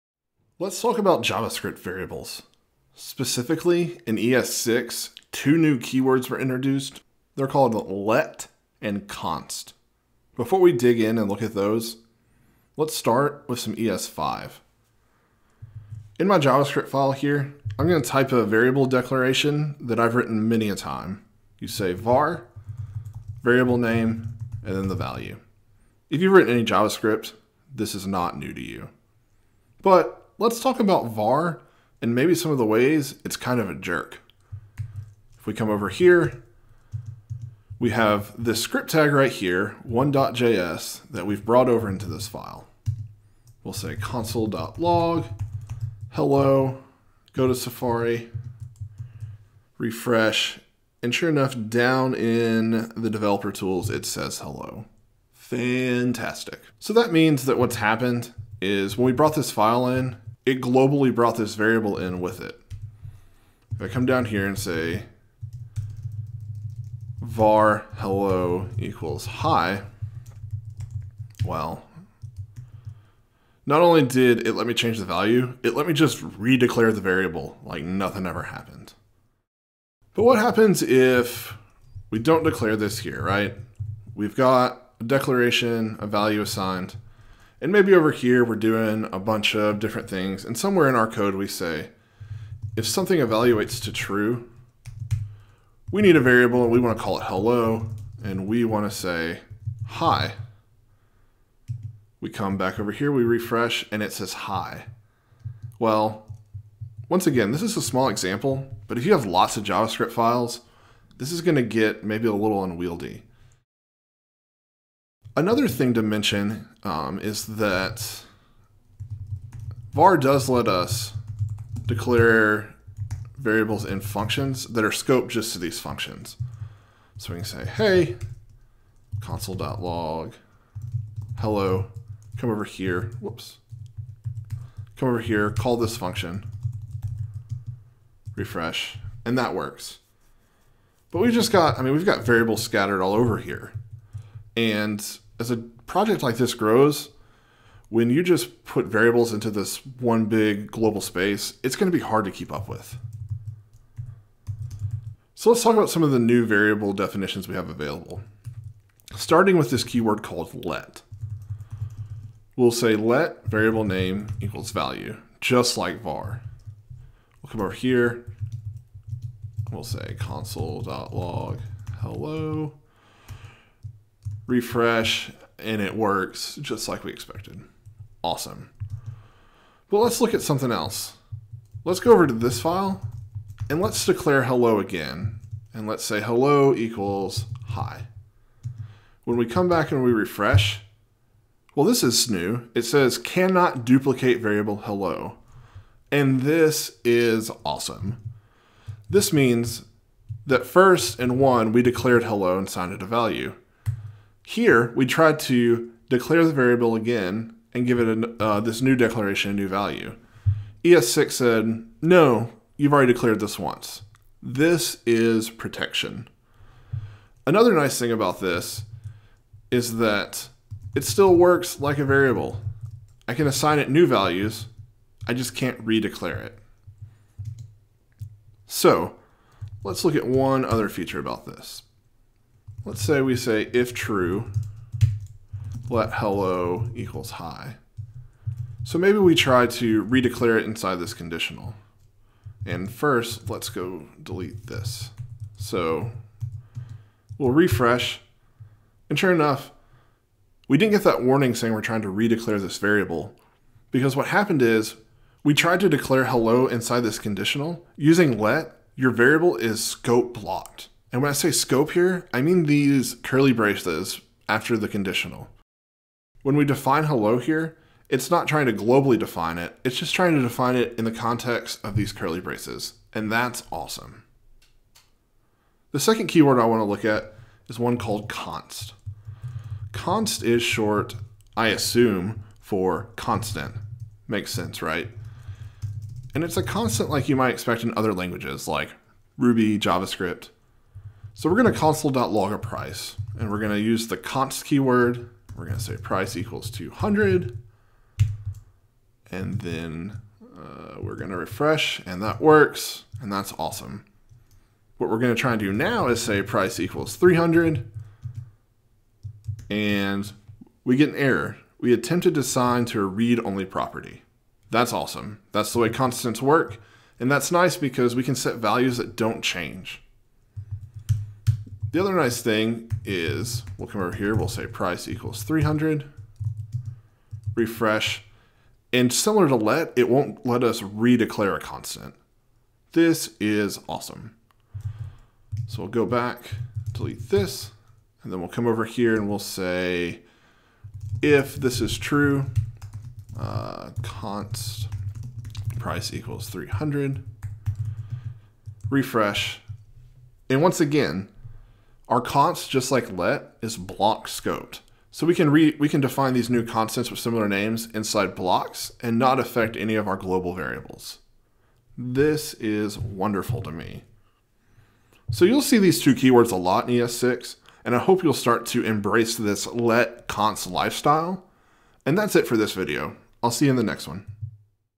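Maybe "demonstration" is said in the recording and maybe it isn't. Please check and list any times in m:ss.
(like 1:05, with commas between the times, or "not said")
not said.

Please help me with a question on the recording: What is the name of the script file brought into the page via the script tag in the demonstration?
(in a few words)
one.js.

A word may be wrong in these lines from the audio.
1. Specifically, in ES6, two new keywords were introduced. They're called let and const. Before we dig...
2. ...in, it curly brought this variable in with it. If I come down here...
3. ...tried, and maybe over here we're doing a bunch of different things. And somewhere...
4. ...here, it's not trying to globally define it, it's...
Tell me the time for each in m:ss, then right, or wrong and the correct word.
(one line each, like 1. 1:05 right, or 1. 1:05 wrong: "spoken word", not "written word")
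1. 0:02 right
2. 0:59 wrong: "globally", not "curly"
3. 1:26 wrong: "assigned", not "tried"
4. 4:27 right.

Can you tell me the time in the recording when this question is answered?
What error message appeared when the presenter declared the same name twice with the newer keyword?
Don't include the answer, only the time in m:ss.
3:13.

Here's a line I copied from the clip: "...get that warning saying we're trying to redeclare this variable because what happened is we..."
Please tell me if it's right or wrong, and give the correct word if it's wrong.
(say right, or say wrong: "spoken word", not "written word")
right.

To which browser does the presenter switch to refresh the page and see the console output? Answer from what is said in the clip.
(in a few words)
Safari.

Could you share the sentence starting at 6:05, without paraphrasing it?
So you'll see these two keywords a lot in ES6, and I hope you'll start to embrace this let const lifestyle.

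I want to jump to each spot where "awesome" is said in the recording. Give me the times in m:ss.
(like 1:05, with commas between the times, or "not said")
2:58, 3:17, 4:33, 5:03, 5:14, 5:33.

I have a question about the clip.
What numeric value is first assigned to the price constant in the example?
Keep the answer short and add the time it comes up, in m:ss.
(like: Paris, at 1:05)
200, at 4:56.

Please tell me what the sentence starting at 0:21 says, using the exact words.
You say var, variable name, and then the value.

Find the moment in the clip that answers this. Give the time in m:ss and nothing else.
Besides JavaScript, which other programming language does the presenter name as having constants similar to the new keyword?
4:49.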